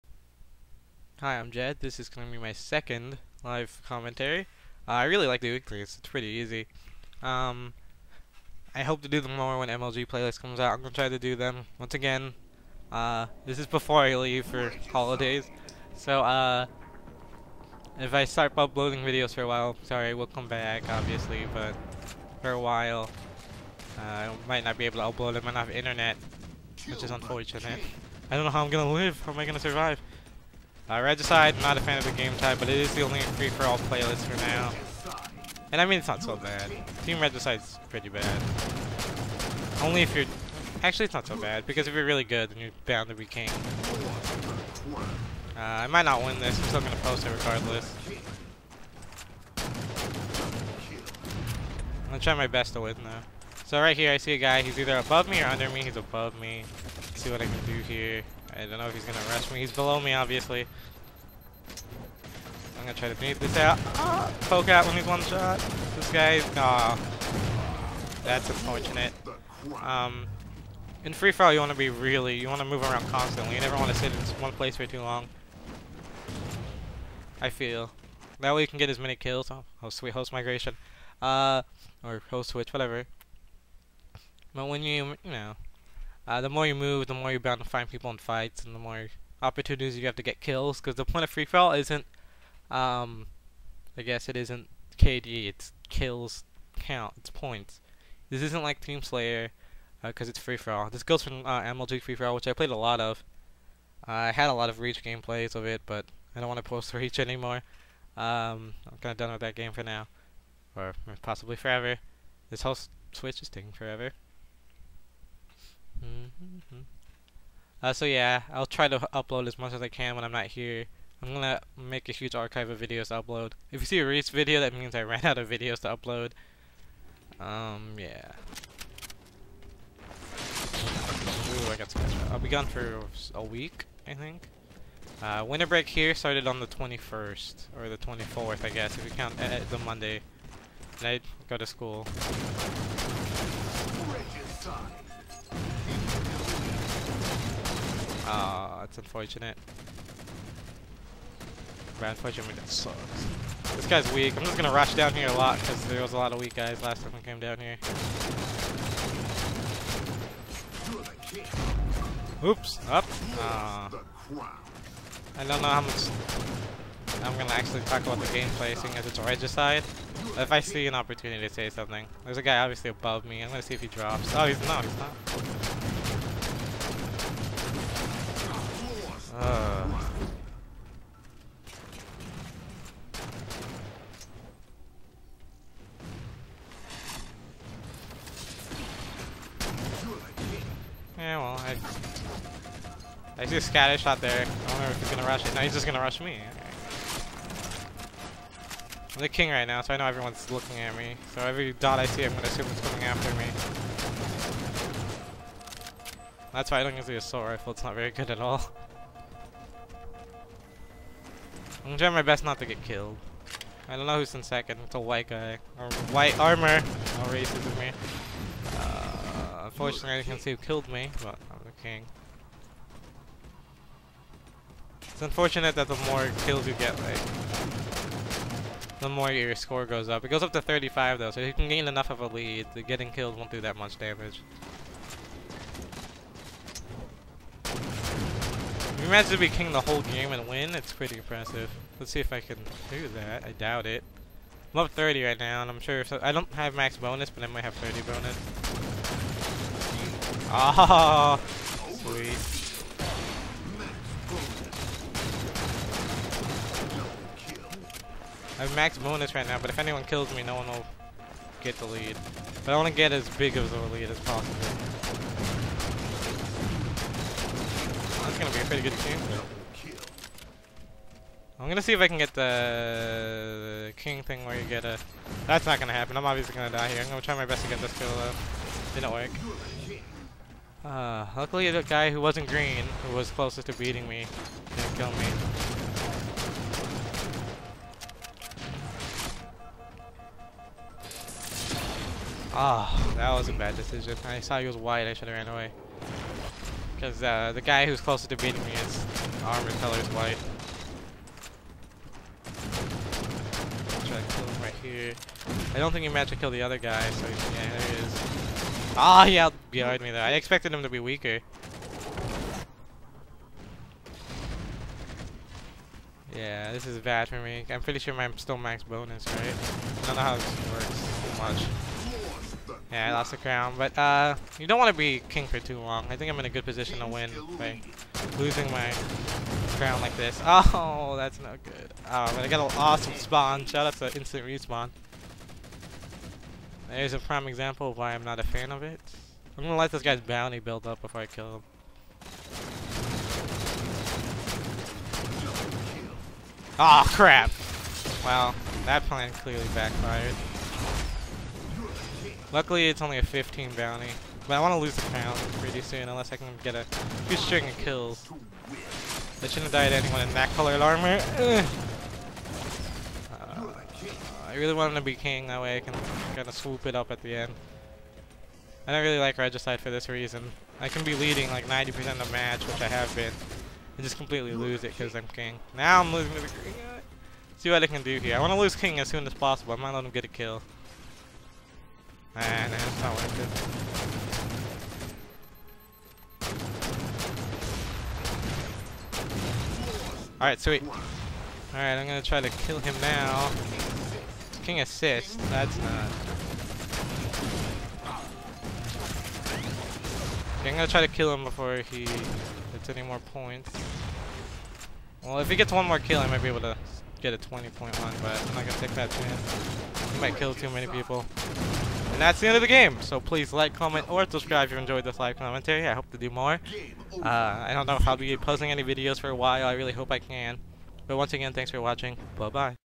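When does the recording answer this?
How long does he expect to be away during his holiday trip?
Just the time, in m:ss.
2:13.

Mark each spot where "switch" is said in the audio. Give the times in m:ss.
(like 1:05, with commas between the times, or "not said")
1:22, 1:53.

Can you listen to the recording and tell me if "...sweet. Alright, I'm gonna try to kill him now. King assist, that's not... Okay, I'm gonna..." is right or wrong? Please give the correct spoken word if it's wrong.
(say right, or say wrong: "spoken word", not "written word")
right.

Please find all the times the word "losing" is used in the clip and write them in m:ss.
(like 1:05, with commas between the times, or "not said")
5:28, 6:16.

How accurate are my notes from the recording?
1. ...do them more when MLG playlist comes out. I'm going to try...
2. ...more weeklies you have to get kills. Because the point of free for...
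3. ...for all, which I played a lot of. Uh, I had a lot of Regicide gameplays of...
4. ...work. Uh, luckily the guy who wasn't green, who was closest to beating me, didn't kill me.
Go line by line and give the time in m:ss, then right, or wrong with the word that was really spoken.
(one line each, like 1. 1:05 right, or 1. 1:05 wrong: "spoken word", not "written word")
1. 0:09 right
2. 1:28 wrong: "opportunities", not "weeklies"
3. 1:42 wrong: "Reach", not "Regicide"
4. 4:39 right.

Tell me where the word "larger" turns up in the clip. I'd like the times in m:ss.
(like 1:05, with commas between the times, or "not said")
not said.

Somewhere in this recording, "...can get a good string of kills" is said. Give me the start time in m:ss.
5:56.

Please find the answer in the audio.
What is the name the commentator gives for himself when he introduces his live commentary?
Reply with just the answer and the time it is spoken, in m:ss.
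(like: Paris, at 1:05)
Jed, at 0:01.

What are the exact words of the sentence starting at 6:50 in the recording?
He might kill too many people.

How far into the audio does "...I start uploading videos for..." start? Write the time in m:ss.
0:18.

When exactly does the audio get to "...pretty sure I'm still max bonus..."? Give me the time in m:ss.
5:17.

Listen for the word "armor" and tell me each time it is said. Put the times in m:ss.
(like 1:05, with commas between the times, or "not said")
3:36, 4:59, 6:00.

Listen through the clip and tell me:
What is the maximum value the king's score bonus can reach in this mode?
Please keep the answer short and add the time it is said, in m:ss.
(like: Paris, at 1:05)
35, at 3:50.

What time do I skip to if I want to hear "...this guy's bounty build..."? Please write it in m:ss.
5:39.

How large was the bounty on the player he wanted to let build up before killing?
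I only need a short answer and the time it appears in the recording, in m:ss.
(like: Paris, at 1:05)
15, at 5:53.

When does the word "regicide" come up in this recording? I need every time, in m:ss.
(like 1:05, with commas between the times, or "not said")
0:31, 0:37, 2:49, 6:09.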